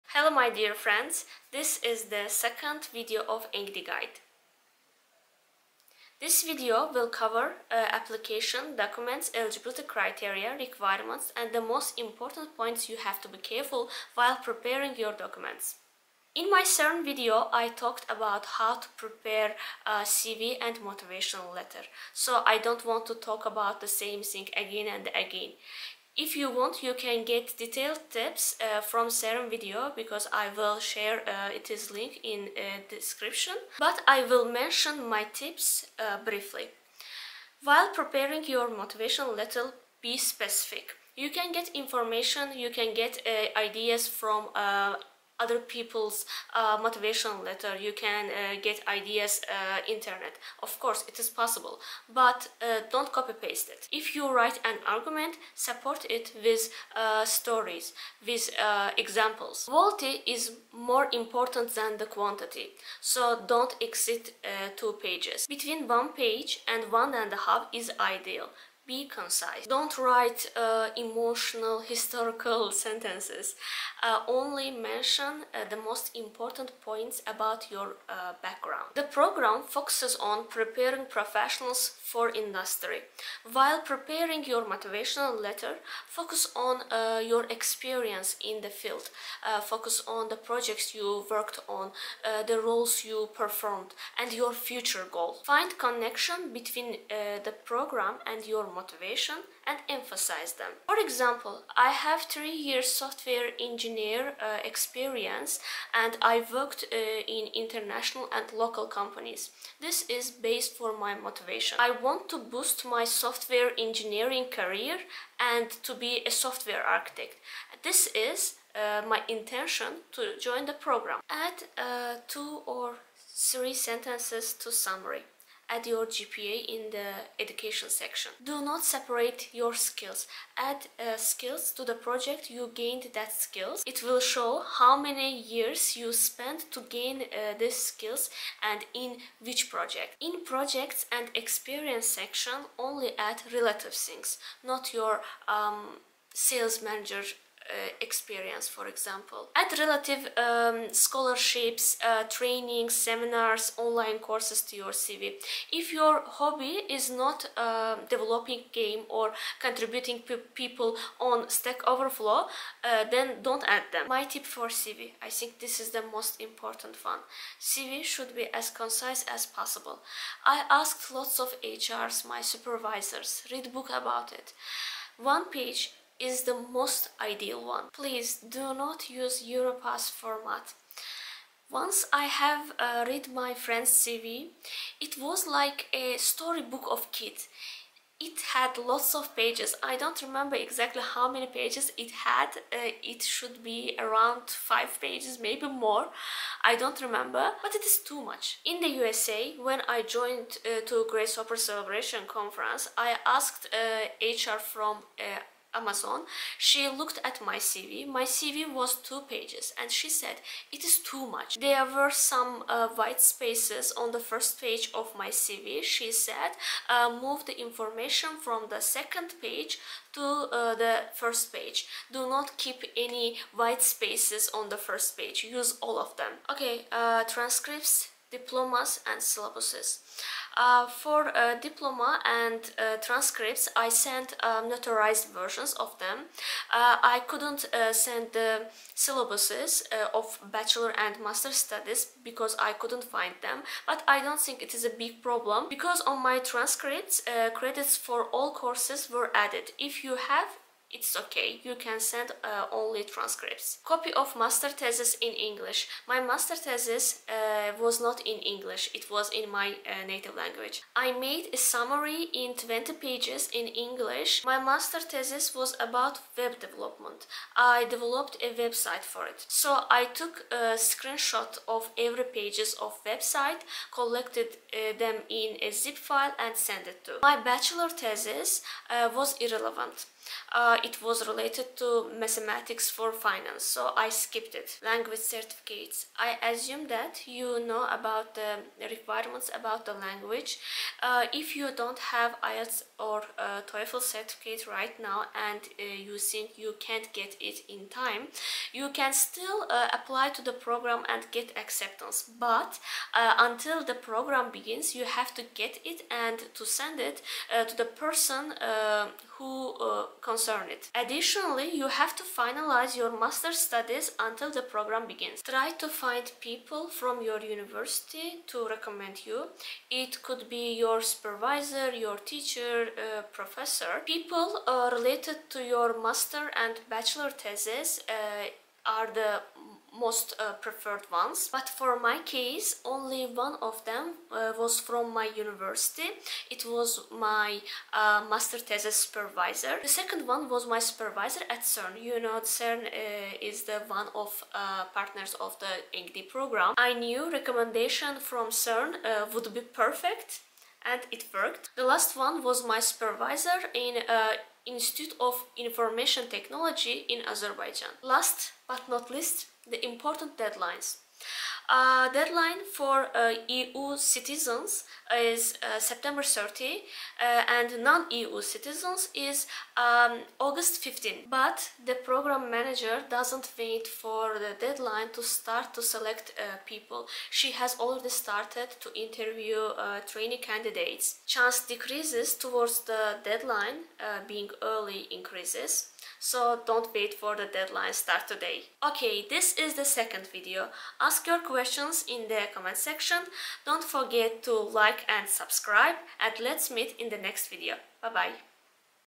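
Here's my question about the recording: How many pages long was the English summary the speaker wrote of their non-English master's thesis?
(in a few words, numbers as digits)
20.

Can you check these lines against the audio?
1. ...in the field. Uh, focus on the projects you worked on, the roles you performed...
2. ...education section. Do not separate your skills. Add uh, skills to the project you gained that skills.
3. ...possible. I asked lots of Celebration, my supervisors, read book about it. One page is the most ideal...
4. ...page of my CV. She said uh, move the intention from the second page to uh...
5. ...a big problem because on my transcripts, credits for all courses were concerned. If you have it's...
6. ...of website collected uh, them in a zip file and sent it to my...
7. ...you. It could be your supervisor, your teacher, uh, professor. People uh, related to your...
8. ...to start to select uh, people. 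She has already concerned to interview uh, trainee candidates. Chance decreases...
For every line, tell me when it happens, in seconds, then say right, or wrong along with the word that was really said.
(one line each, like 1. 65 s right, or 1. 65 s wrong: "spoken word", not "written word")
1. 88 s right
2. 127 s right
3. 169 s wrong: "HRs", not "Celebration"
4. 214 s wrong: "information", not "intention"
5. 244 s wrong: "added", not "concerned"
6. 272 s right
7. 319 s right
8. 375 s wrong: "started", not "concerned".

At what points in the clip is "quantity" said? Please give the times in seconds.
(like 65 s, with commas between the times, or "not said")
62 s.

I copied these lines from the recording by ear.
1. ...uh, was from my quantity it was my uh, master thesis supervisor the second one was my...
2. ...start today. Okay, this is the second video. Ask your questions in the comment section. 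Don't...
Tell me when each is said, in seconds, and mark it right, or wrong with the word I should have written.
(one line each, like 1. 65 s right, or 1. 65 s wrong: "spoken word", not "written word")
1. 334 s wrong: "university", not "quantity"
2. 387 s right.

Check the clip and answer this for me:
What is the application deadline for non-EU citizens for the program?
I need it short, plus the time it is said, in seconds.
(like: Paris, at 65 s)
August 15, at 370 s.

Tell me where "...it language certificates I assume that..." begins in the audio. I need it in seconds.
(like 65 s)
284 s.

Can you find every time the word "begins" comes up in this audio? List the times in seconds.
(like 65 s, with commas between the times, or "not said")
304 s, 315 s.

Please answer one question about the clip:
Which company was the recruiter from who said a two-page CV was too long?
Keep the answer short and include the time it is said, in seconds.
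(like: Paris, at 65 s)
Amazon, at 205 s.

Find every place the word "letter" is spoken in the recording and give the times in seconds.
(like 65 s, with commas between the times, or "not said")
21 s, 39 s, 47 s, 85 s.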